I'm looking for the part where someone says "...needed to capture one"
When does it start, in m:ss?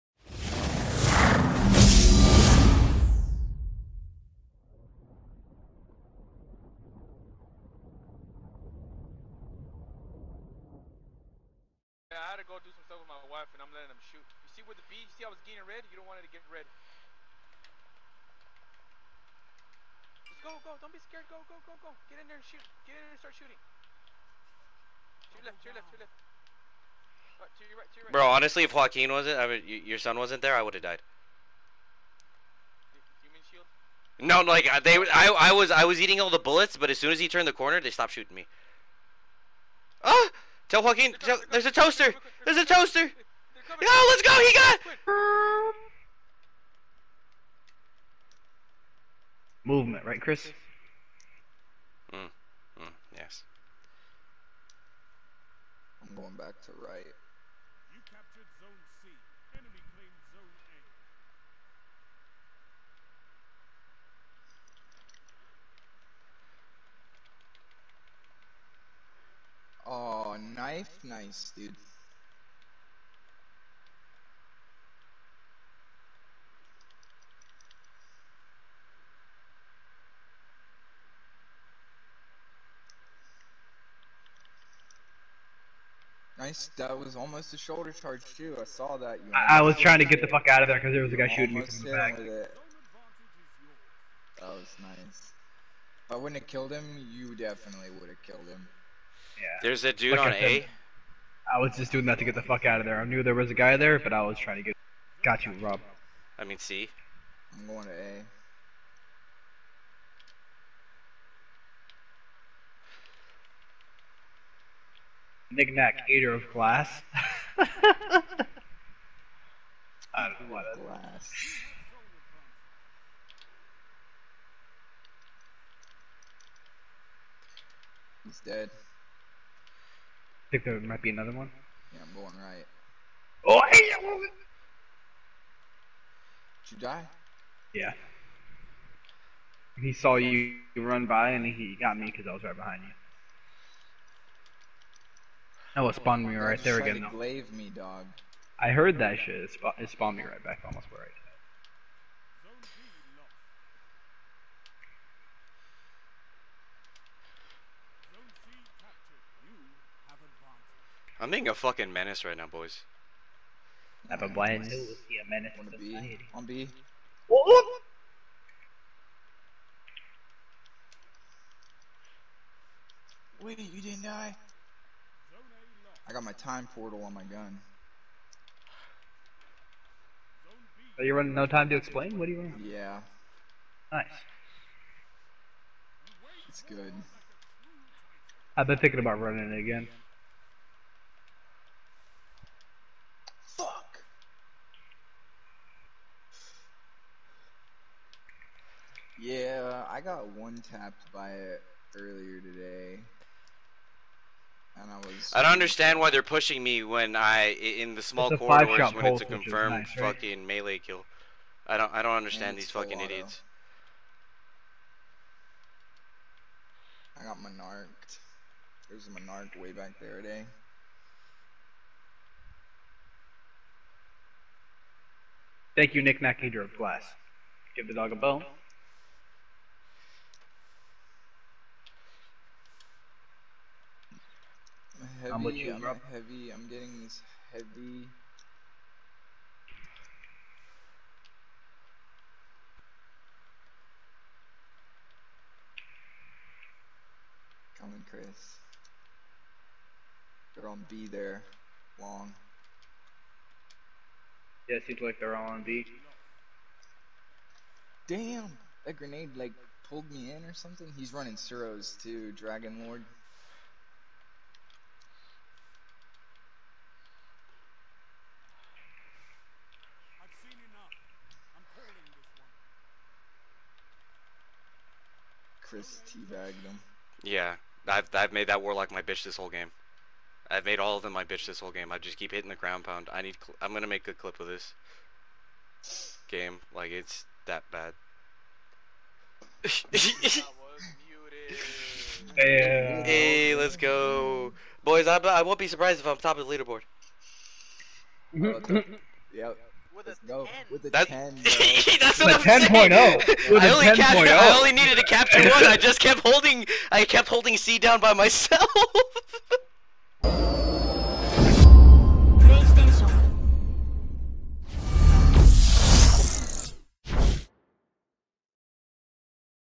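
5:04.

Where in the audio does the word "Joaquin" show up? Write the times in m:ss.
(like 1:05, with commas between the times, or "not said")
0:28, 0:40.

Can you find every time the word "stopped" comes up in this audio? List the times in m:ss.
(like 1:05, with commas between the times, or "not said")
0:37.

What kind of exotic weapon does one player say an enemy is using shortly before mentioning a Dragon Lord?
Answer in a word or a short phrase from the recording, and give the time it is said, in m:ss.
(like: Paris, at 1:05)
Suros, at 4:21.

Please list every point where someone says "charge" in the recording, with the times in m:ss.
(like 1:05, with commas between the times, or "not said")
1:27.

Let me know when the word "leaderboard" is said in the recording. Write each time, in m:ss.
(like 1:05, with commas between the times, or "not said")
4:56.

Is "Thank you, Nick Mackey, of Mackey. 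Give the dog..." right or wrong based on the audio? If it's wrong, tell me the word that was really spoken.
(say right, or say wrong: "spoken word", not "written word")
wrong: "Glass", not "Mackey".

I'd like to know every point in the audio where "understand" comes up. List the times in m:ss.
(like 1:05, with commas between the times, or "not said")
3:25, 3:32.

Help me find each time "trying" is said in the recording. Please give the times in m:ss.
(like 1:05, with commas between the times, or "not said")
1:29, 1:44.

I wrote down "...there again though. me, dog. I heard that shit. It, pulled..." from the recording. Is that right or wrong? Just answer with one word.
wrong.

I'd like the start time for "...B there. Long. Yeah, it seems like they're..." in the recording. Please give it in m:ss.
4:10.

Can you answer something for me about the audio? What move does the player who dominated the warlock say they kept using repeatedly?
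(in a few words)
ground pound.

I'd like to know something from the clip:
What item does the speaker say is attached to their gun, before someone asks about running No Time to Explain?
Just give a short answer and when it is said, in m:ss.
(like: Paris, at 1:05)
time portal, at 2:56.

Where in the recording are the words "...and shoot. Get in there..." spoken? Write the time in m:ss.
0:22.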